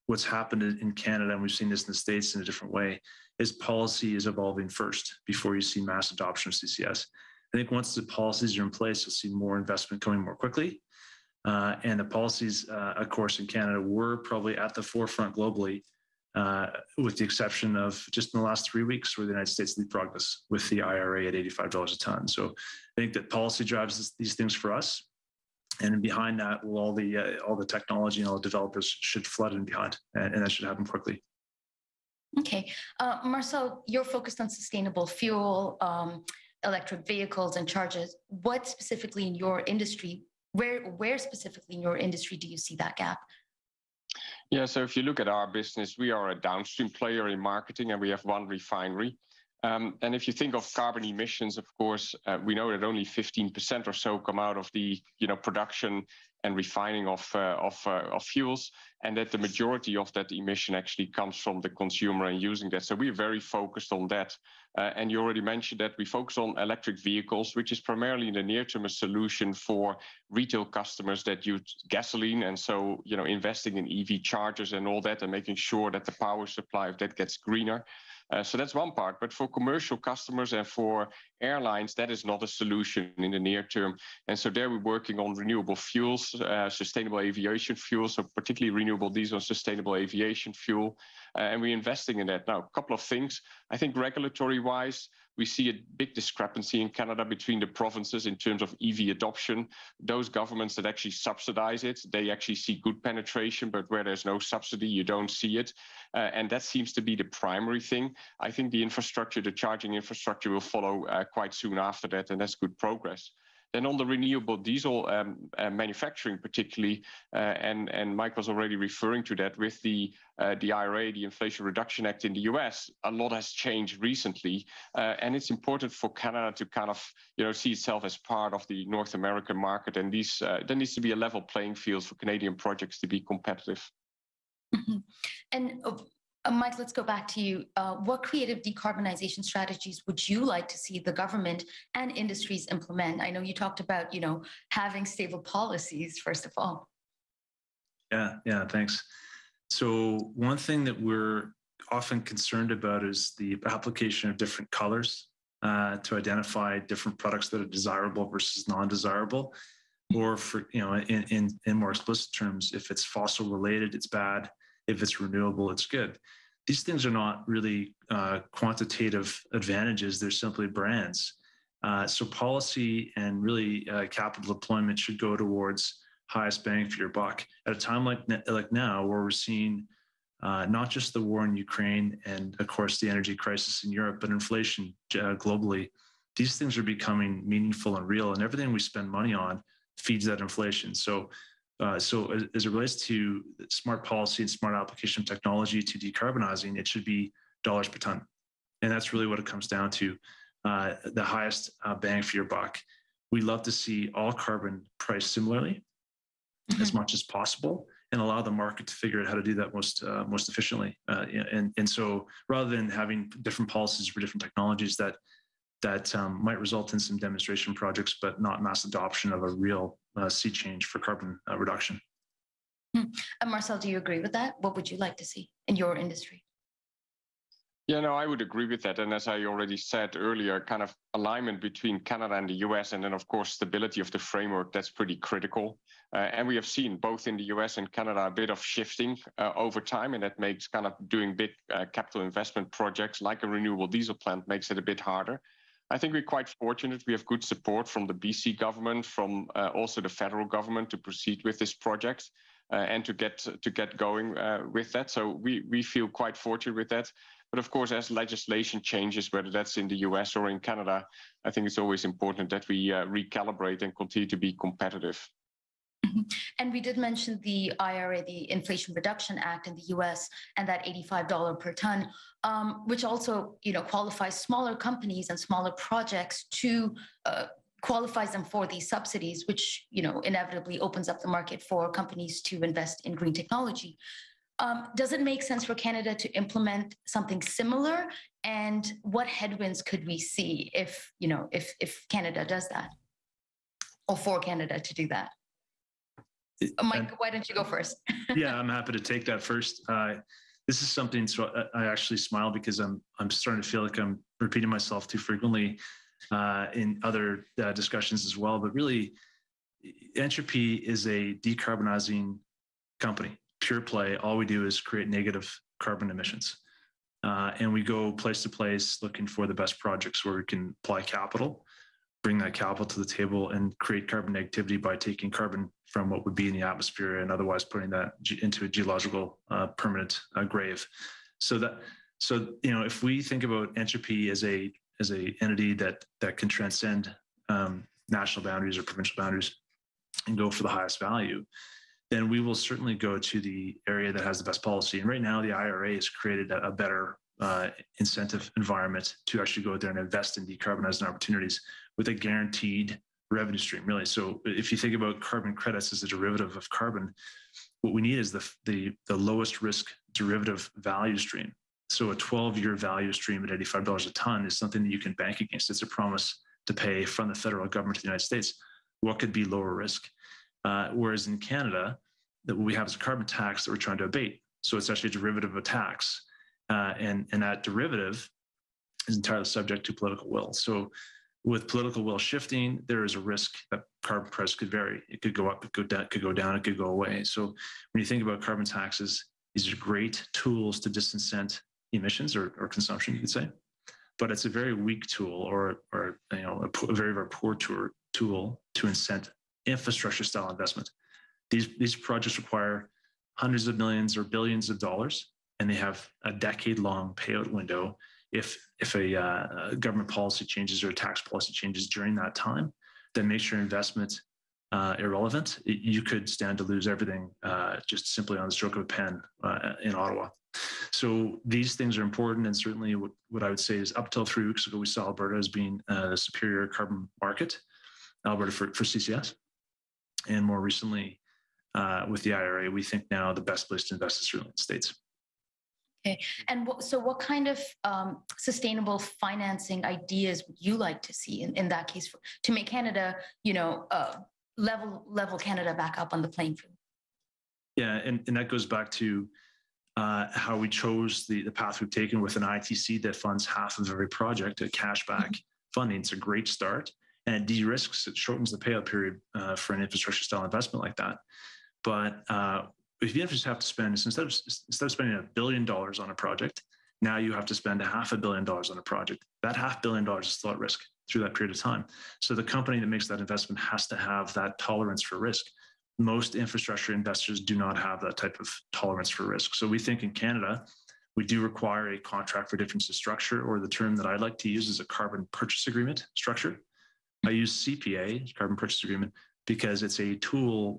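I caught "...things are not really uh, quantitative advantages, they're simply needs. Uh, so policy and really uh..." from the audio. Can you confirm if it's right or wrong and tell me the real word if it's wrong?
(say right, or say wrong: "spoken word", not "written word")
wrong: "brands", not "needs".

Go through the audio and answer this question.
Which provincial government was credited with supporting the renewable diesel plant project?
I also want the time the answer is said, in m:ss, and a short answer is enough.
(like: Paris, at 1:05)
BC government, at 4:08.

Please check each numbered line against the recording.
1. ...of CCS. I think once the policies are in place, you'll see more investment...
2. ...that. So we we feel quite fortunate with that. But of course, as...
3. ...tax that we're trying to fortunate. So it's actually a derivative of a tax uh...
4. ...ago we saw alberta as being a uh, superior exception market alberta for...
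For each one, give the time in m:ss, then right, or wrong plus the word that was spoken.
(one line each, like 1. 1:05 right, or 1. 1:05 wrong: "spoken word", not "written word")
1. 0:06 right
2. 4:14 right
3. 6:13 wrong: "abate", not "fortunate"
4. 7:04 wrong: "carbon", not "exception".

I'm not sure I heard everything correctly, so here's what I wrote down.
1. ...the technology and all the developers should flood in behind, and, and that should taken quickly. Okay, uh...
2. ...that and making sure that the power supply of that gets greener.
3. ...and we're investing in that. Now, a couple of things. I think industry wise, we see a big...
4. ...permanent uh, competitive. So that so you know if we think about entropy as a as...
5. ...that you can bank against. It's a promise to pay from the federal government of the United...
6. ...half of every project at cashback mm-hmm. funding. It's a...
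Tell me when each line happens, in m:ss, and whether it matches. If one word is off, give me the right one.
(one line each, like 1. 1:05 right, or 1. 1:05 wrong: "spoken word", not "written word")
1. 0:27 wrong: "happen", not "taken"
2. 1:15 right
3. 1:31 wrong: "regulatory", not "industry"
4. 5:29 wrong: "grave", not "competitive"
5. 6:04 right
6. 7:33 right.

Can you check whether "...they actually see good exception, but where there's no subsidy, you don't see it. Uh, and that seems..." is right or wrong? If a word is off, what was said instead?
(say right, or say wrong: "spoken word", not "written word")
wrong: "penetration", not "exception".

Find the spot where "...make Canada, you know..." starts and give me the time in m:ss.
7:22.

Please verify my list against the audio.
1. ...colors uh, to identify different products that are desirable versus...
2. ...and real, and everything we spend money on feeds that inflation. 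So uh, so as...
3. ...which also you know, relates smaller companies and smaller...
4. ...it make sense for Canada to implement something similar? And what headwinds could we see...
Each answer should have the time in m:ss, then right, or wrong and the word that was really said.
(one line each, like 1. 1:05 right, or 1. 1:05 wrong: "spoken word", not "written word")
1. 2:34 right
2. 3:07 right
3. 4:32 wrong: "qualifies", not "relates"
4. 4:45 right.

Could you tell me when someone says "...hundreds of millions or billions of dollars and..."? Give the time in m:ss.
6:43.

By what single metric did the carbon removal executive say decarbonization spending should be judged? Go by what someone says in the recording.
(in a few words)
Dollars per ton.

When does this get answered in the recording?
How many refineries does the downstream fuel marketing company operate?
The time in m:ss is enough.
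0:48.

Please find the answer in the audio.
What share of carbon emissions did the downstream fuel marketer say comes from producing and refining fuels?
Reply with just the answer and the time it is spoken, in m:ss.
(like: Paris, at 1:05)
15%, at 0:53.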